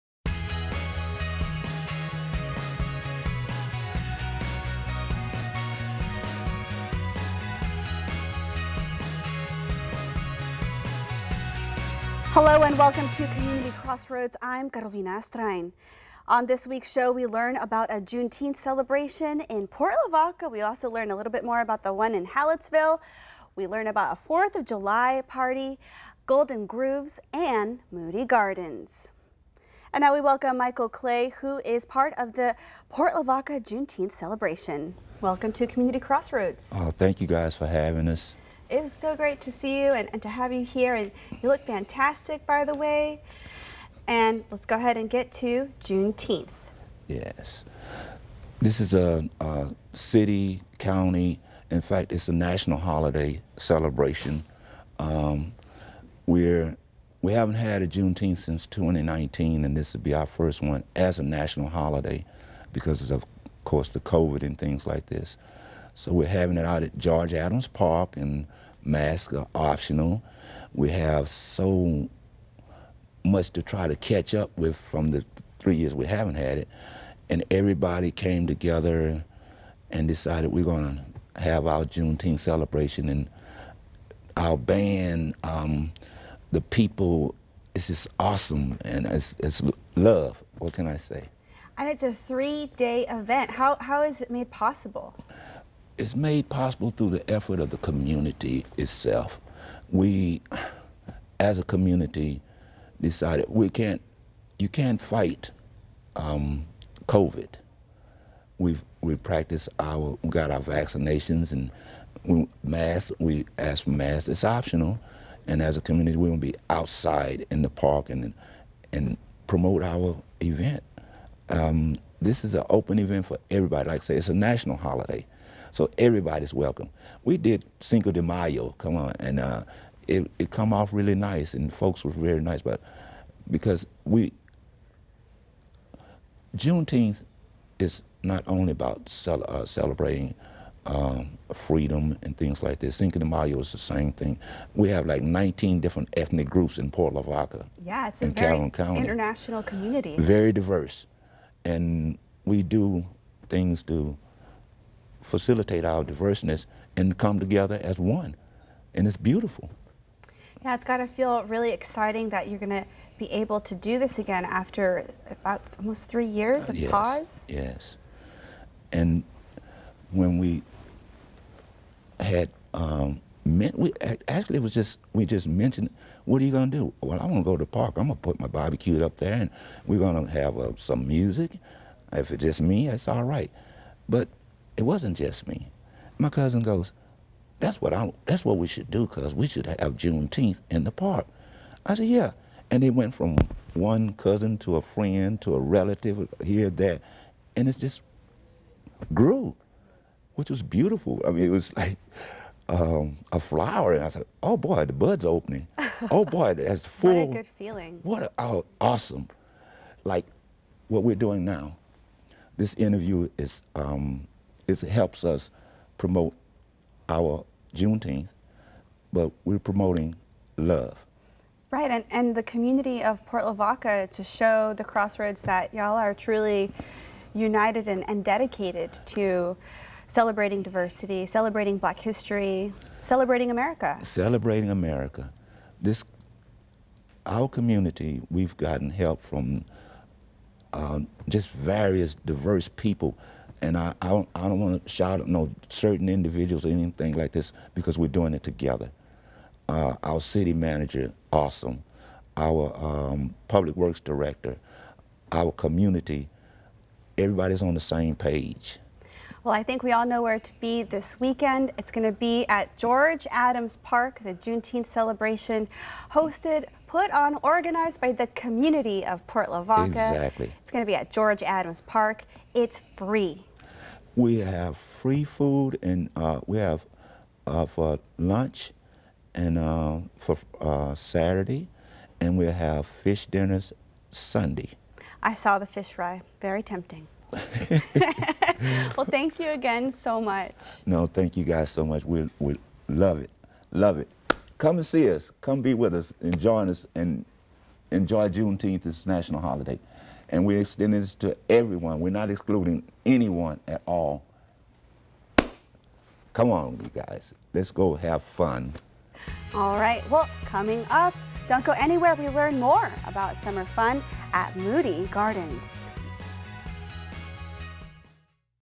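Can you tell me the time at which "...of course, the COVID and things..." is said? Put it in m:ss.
1:03.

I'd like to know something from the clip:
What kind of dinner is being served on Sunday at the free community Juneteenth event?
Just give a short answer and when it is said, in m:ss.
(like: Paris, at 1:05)
Fish dinners, at 4:42.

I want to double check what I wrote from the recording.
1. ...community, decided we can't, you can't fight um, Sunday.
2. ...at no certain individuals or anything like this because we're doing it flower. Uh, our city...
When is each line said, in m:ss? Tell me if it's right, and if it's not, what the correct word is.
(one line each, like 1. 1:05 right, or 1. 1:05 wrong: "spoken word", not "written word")
1. 1:41 wrong: "COVID", not "Sunday"
2. 4:05 wrong: "together", not "flower".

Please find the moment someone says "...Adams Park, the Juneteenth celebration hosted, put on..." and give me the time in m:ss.
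4:23.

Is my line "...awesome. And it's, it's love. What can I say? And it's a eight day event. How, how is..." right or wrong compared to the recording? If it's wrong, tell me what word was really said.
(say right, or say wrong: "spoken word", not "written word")
wrong: "three", not "eight".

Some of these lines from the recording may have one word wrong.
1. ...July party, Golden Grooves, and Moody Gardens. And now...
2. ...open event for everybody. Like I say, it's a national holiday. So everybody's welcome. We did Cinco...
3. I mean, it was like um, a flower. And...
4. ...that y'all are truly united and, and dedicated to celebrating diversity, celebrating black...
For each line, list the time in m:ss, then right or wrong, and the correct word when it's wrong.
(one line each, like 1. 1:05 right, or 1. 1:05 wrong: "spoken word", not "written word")
1. 0:24 right
2. 2:02 right
3. 3:21 right
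4. 3:45 right.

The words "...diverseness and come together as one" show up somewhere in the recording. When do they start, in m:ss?
2:36.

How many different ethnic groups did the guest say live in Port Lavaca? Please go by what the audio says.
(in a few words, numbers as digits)
19.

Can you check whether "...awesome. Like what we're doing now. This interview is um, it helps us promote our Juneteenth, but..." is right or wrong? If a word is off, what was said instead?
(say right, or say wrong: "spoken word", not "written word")
right.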